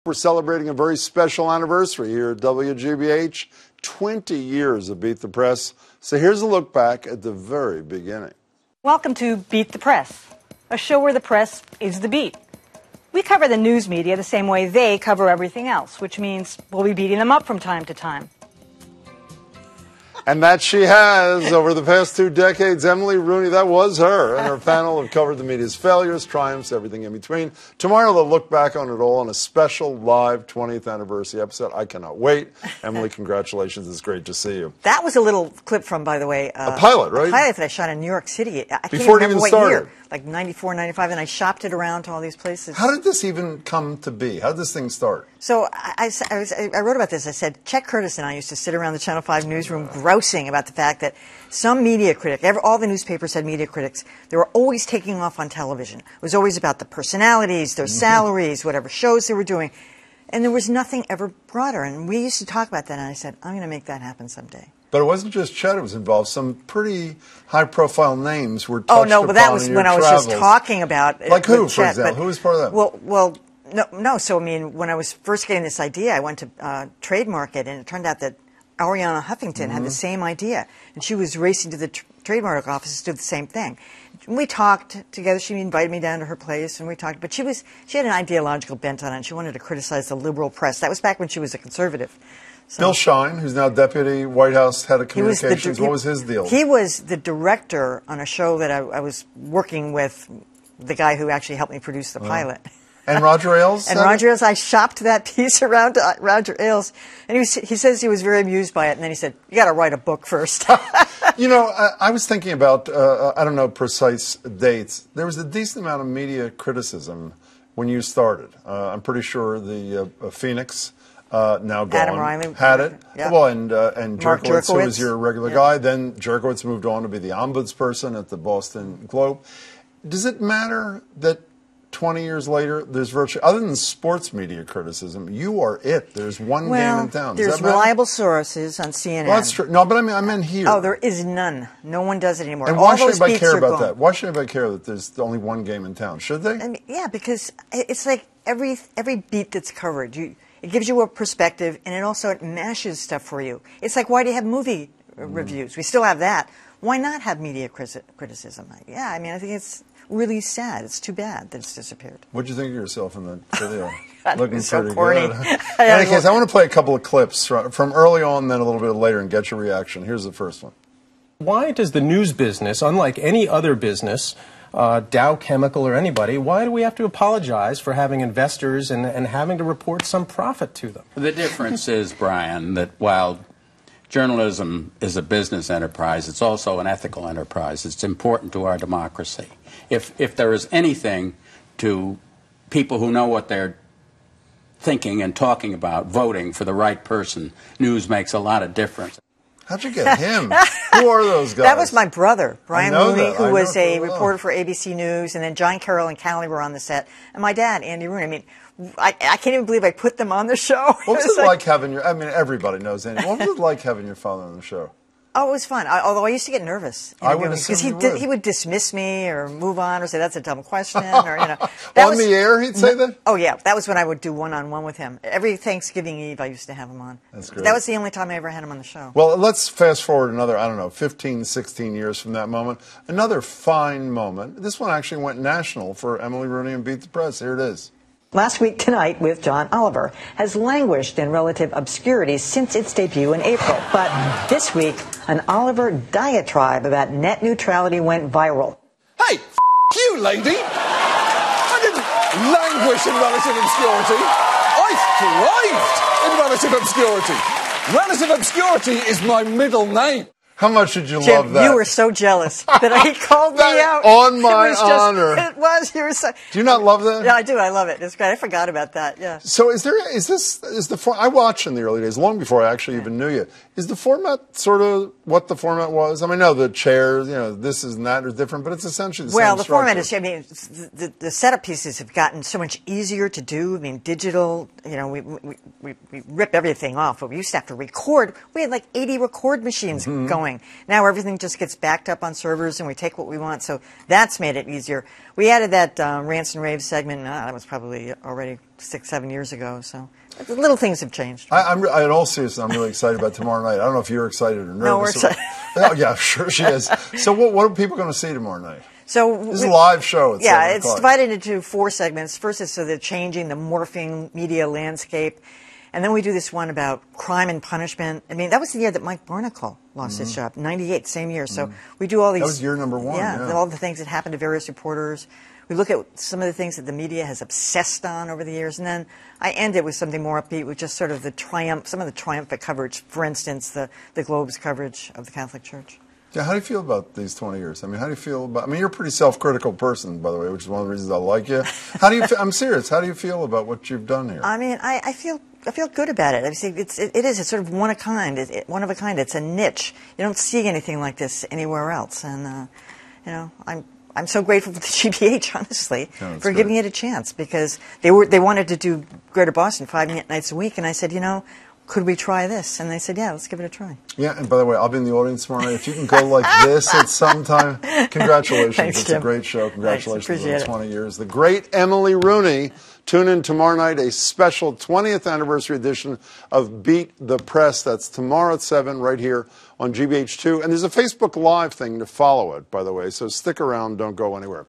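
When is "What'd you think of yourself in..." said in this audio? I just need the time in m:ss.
2:42.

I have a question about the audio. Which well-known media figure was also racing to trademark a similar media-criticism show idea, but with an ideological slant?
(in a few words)
Arianna Huffington.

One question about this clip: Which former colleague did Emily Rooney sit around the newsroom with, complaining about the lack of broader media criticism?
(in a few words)
Chet Curtis.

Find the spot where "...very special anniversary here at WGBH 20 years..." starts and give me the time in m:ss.
0:00.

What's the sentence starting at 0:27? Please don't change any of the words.
Tomorrow they'll look back on it all on a special live 20th anniversary episode.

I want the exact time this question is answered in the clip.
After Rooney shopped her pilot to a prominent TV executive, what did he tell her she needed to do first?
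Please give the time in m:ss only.
1:49.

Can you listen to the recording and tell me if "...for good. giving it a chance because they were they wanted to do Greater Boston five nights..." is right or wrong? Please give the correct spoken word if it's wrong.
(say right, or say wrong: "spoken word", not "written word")
right.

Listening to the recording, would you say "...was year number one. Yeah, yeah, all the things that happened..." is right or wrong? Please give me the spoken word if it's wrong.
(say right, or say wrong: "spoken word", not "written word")
right.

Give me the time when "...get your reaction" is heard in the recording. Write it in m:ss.
2:49.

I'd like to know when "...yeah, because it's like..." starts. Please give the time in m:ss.
2:26.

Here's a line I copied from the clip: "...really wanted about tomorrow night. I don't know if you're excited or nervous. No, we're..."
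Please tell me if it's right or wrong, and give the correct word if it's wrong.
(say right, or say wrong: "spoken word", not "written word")
wrong: "excited", not "wanted".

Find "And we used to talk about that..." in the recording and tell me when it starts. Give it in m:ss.
1:01.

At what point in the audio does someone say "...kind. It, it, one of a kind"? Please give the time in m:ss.
5:47.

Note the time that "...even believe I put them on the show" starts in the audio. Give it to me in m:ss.
3:29.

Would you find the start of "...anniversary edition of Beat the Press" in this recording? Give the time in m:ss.
6:15.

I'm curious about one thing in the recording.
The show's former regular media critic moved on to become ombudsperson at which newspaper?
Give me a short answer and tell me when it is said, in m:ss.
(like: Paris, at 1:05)
The Boston Globe, at 2:08.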